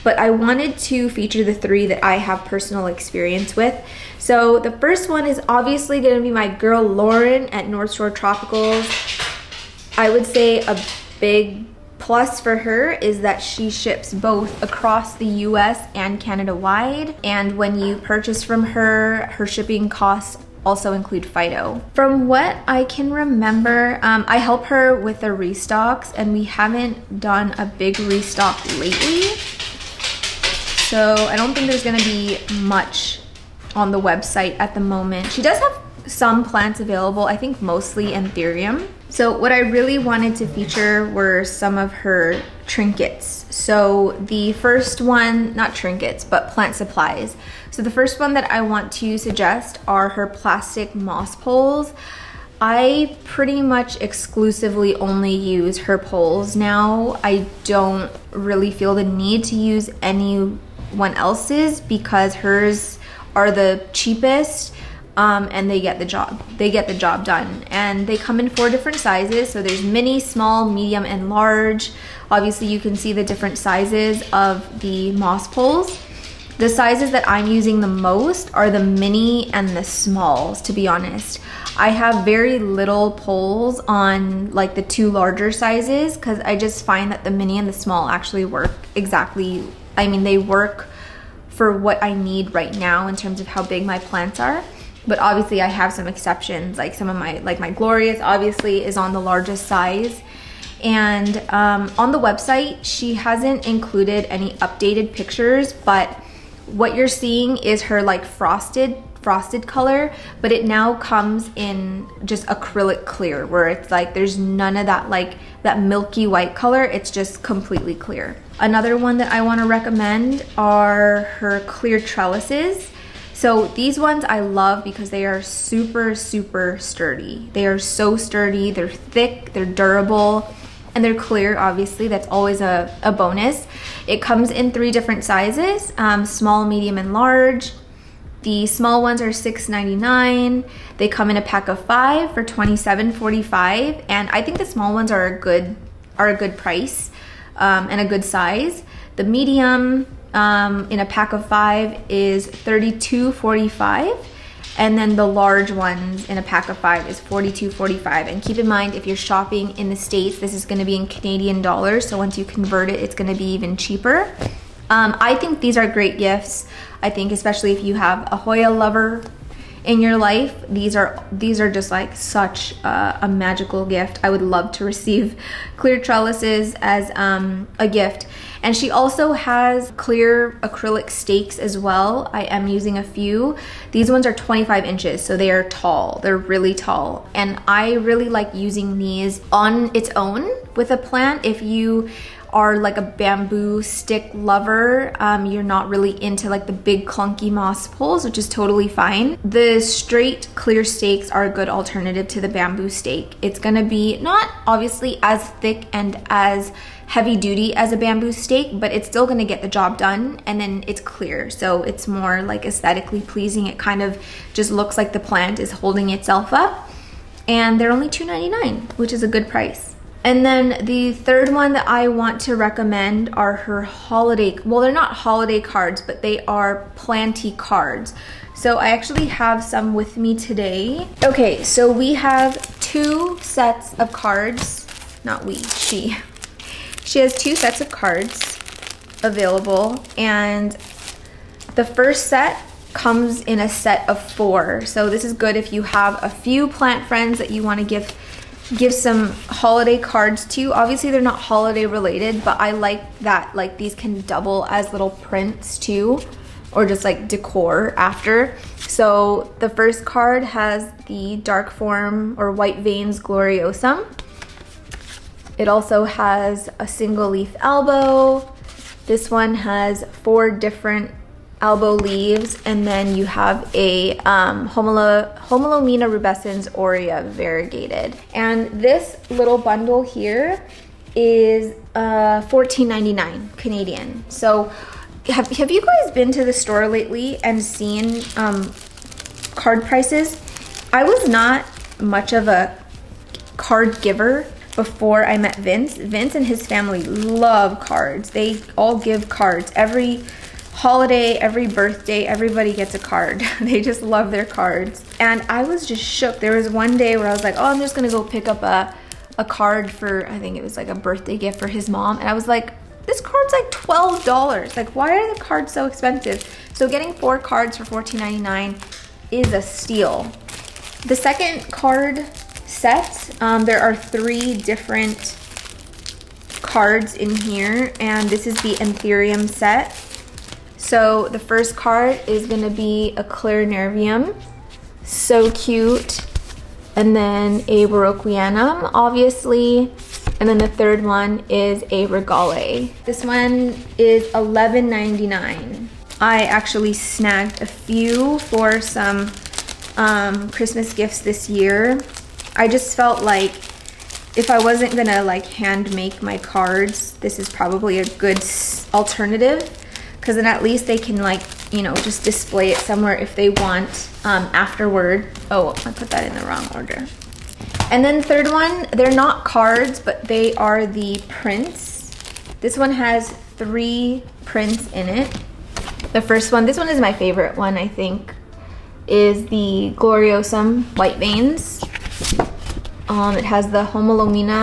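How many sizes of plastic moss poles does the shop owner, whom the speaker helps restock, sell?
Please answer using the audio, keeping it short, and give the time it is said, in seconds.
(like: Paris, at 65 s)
4, at 68 s.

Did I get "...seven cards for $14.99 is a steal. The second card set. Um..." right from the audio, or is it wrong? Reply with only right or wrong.
wrong.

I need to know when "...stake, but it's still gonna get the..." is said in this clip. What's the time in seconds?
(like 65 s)
208 s.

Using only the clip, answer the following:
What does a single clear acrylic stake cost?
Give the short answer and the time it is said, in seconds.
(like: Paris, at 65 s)
$2.99, at 218 s.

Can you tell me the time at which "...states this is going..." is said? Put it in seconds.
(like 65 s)
159 s.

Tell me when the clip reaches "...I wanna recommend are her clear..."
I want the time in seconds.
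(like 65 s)
119 s.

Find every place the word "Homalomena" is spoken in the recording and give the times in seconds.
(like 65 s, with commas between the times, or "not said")
275 s, 383 s.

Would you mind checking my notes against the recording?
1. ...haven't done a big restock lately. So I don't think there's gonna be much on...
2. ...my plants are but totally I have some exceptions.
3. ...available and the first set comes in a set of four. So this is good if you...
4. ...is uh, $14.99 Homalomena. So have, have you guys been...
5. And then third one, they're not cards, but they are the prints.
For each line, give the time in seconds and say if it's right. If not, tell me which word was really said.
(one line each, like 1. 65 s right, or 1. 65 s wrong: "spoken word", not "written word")
1. 26 s right
2. 93 s wrong: "obviously", not "totally"
3. 239 s right
4. 281 s wrong: "Canadian", not "Homalomena"
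5. 367 s right.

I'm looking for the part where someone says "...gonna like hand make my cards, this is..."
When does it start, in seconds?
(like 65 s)
354 s.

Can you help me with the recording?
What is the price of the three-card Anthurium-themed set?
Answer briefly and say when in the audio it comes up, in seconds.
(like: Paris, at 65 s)
$11.99, at 344 s.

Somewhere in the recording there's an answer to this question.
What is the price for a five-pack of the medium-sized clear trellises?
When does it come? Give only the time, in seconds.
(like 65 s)
152 s.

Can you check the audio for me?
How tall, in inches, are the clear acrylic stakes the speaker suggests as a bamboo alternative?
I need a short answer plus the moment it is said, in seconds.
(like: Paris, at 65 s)
25 inches, at 184 s.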